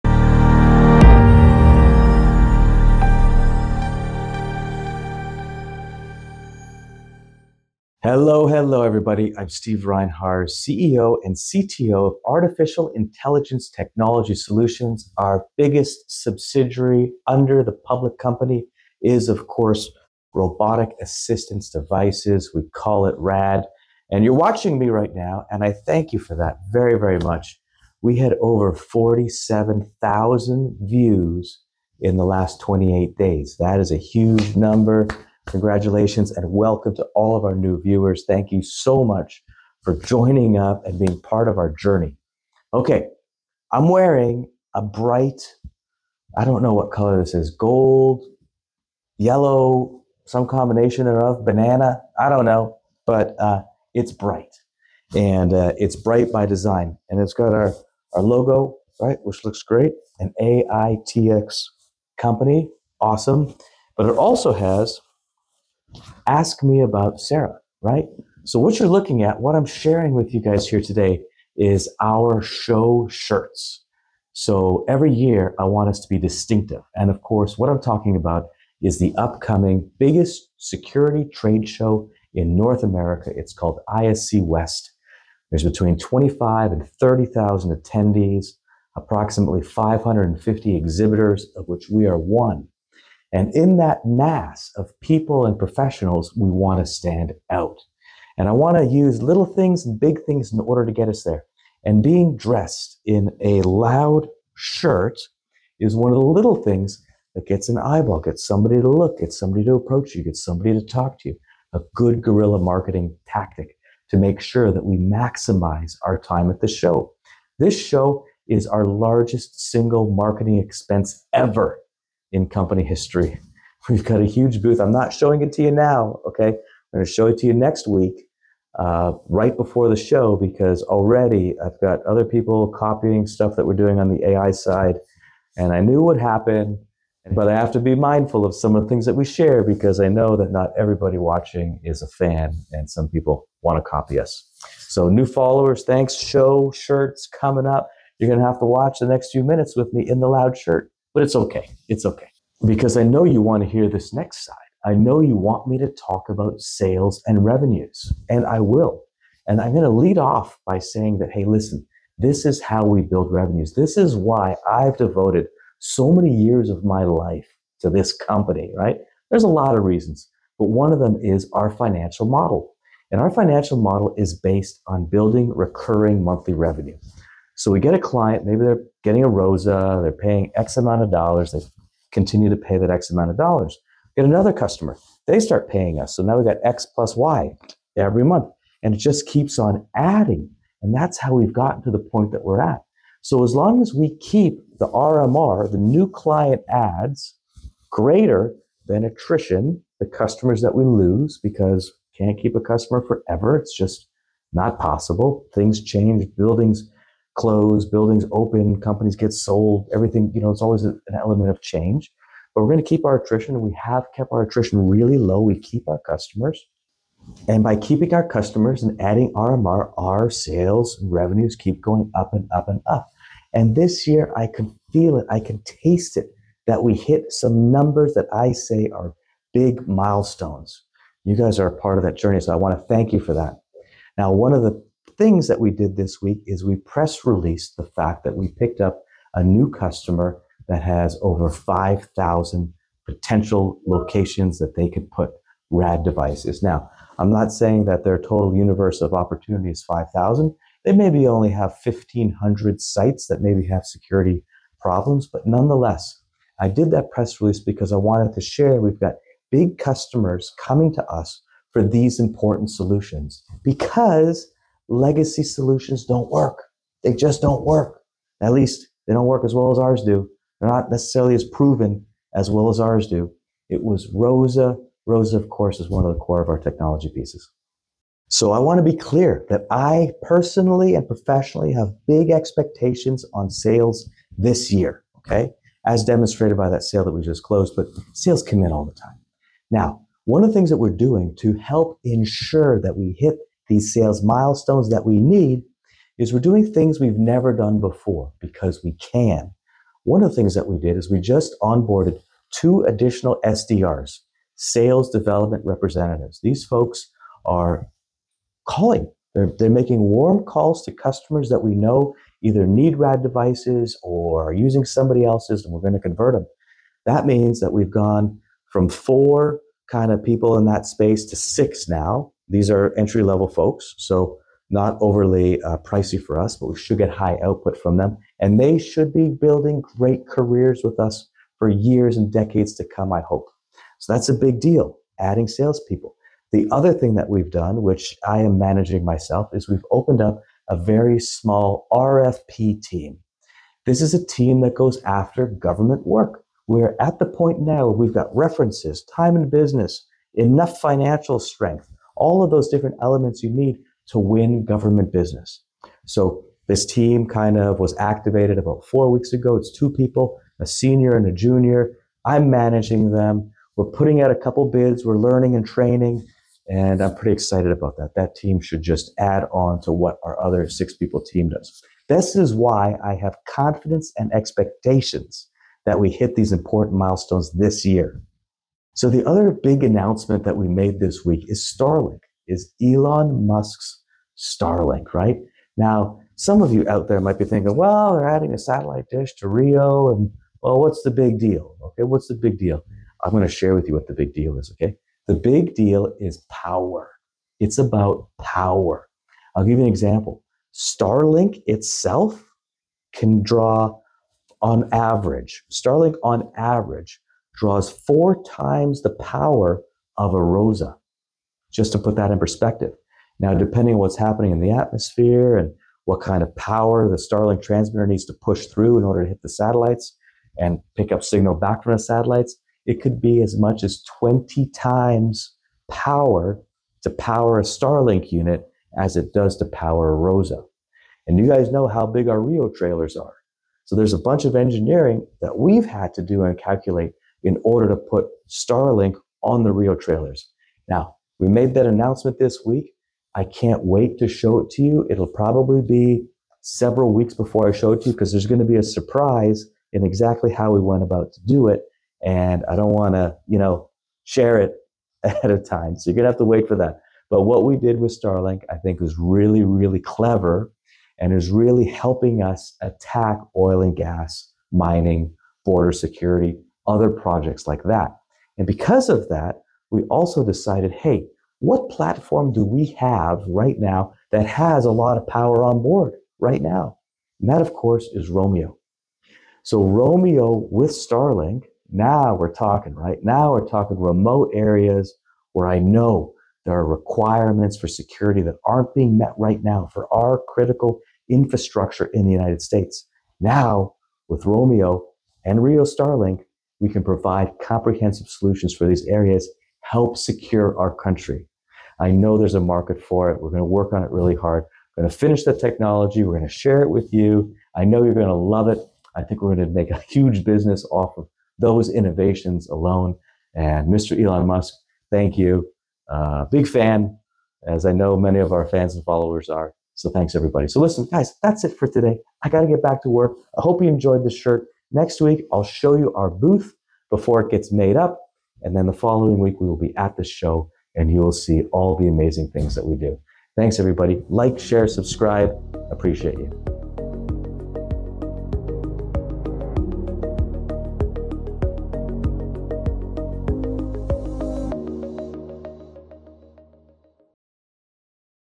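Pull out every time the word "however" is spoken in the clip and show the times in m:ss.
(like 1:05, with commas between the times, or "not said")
not said.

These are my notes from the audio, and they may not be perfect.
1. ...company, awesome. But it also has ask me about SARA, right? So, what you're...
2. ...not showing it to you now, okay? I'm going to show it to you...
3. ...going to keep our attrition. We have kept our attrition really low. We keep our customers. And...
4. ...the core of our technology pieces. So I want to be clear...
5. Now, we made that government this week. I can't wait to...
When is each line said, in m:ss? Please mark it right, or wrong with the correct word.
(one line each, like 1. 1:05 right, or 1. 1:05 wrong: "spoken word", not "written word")
1. 1:02 right
2. 2:04 right
3. 3:32 right
4. 4:36 right
5. 7:20 wrong: "announcement", not "government".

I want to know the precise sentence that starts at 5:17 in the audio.
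That means that we've gone from four kind of people in that space to six now.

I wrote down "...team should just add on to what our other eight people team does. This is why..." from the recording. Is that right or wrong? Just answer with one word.
wrong.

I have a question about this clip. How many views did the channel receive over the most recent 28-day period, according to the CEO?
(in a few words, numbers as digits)
47,000.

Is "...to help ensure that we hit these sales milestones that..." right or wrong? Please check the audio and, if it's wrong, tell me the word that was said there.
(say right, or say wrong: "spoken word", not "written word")
right.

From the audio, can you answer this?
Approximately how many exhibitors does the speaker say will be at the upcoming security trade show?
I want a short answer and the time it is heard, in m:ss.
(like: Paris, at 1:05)
550, at 1:29.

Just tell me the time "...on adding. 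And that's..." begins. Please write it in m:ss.
3:09.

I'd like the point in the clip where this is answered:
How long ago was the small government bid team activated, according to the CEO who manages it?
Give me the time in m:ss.
5:58.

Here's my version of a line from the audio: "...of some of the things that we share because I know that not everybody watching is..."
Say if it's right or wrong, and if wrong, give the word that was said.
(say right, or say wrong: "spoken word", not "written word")
right.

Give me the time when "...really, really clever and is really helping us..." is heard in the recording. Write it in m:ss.
7:39.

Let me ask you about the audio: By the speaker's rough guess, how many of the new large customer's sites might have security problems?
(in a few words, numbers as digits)
1,500.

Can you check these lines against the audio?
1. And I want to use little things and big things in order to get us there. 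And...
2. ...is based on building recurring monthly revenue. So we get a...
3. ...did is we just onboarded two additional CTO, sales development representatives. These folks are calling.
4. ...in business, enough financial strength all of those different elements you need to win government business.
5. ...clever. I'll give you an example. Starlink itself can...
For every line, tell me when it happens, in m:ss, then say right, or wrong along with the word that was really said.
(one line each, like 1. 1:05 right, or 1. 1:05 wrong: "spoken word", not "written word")
1. 1:38 right
2. 2:54 right
3. 5:00 wrong: "SDRs", not "CTO"
4. 5:49 right
5. 6:38 wrong: "power", not "clever".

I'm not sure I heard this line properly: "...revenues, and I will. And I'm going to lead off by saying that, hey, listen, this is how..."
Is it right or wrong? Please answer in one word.
right.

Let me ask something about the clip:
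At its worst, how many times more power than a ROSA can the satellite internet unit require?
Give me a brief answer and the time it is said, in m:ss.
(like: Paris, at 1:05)
20, at 7:04.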